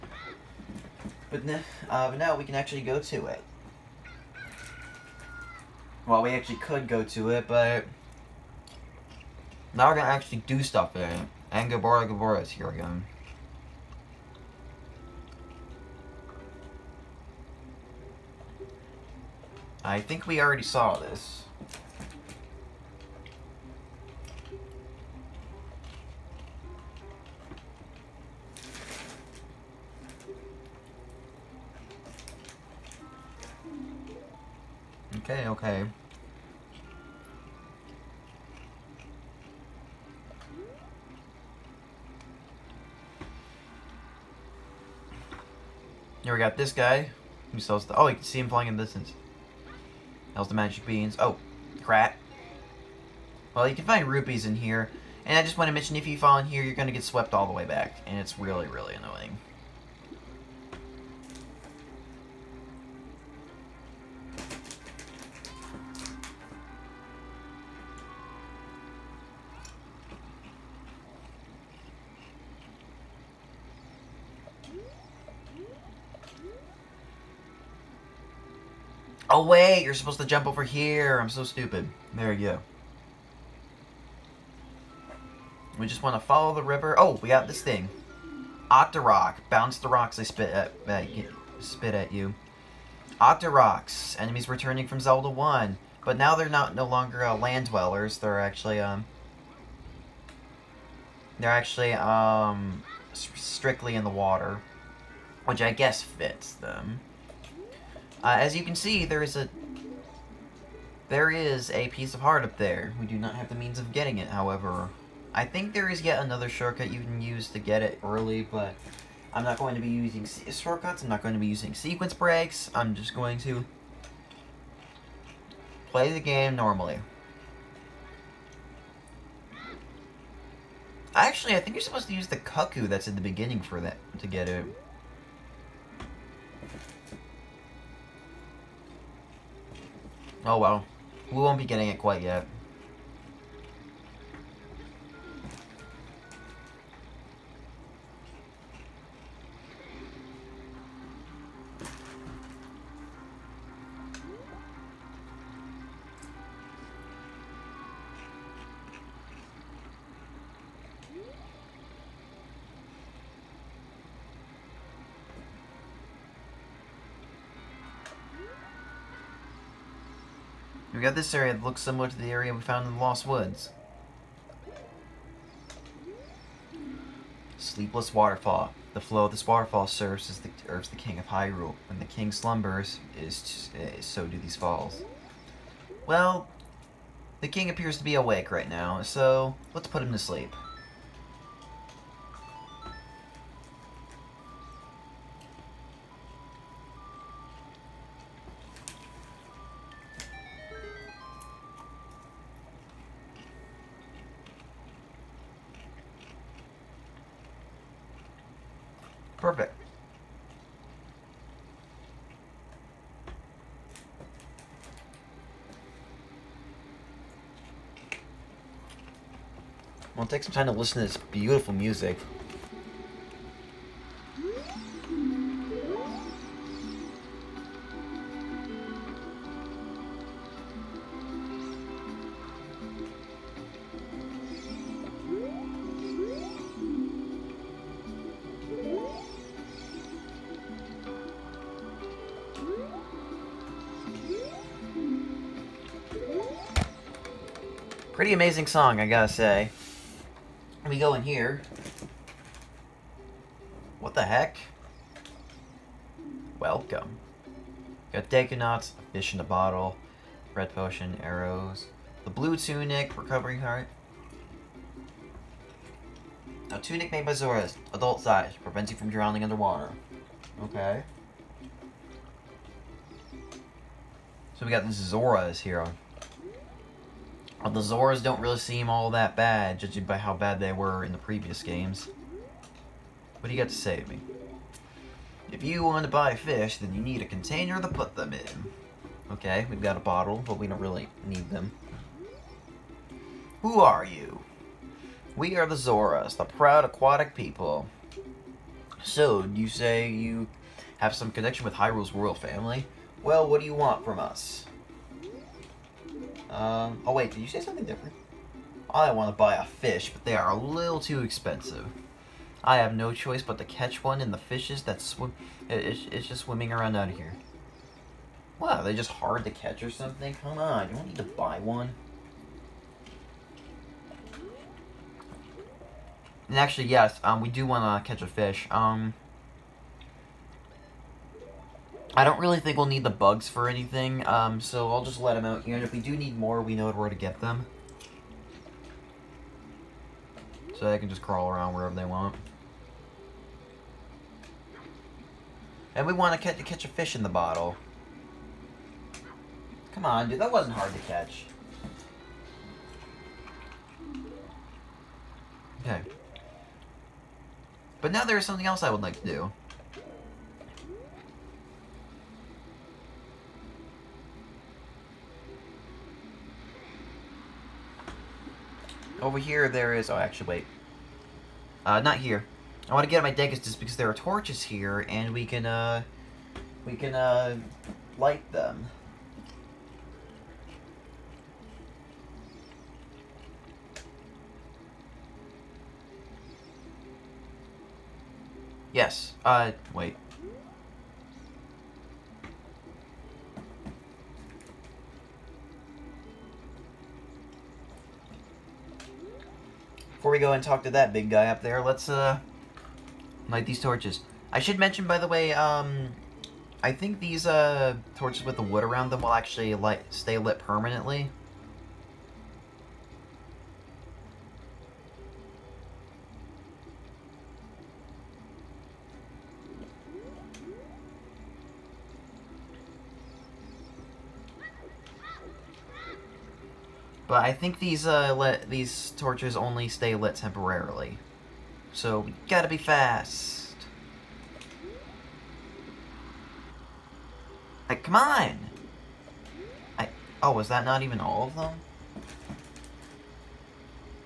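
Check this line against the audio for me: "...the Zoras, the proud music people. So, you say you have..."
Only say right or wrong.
wrong.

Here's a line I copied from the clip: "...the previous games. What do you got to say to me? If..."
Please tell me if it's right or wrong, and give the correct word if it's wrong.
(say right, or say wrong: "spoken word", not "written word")
right.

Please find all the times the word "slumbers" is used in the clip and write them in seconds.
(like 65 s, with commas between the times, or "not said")
182 s.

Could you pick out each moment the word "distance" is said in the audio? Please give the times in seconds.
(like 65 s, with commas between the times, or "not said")
48 s.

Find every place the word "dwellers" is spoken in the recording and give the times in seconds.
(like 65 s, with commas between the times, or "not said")
97 s.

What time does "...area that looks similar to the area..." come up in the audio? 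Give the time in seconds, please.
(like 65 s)
171 s.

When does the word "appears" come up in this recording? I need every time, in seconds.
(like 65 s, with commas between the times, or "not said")
187 s.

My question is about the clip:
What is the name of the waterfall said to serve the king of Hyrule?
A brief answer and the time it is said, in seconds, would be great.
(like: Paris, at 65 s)
Sleepless Waterfall, at 177 s.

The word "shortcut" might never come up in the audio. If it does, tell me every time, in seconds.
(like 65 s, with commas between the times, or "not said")
116 s, 120 s.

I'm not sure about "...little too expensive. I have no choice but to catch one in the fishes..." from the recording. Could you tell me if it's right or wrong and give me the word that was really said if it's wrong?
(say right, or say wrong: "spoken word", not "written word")
right.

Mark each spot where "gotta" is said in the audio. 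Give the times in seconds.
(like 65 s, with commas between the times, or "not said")
249 s, 432 s.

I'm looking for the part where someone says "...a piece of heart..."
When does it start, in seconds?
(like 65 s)
111 s.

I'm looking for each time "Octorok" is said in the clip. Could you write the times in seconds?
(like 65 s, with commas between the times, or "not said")
88 s, 93 s.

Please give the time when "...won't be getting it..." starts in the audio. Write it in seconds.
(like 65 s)
141 s.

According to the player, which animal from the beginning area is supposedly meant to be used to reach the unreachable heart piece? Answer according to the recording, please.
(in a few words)
cuckoo.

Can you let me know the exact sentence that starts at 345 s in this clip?
And we want to catch, catch a fish in the bottle.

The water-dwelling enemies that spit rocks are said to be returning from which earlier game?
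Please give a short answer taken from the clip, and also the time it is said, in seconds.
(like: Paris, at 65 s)
Zelda 1, at 94 s.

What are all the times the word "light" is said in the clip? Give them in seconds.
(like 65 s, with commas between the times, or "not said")
378 s, 403 s, 409 s.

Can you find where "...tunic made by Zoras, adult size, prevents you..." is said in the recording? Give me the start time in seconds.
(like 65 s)
266 s.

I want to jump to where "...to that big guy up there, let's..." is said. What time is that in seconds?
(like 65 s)
400 s.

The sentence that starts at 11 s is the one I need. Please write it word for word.
And Kaepora Gaebora is here again.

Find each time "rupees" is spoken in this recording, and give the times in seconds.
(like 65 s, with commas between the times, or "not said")
54 s.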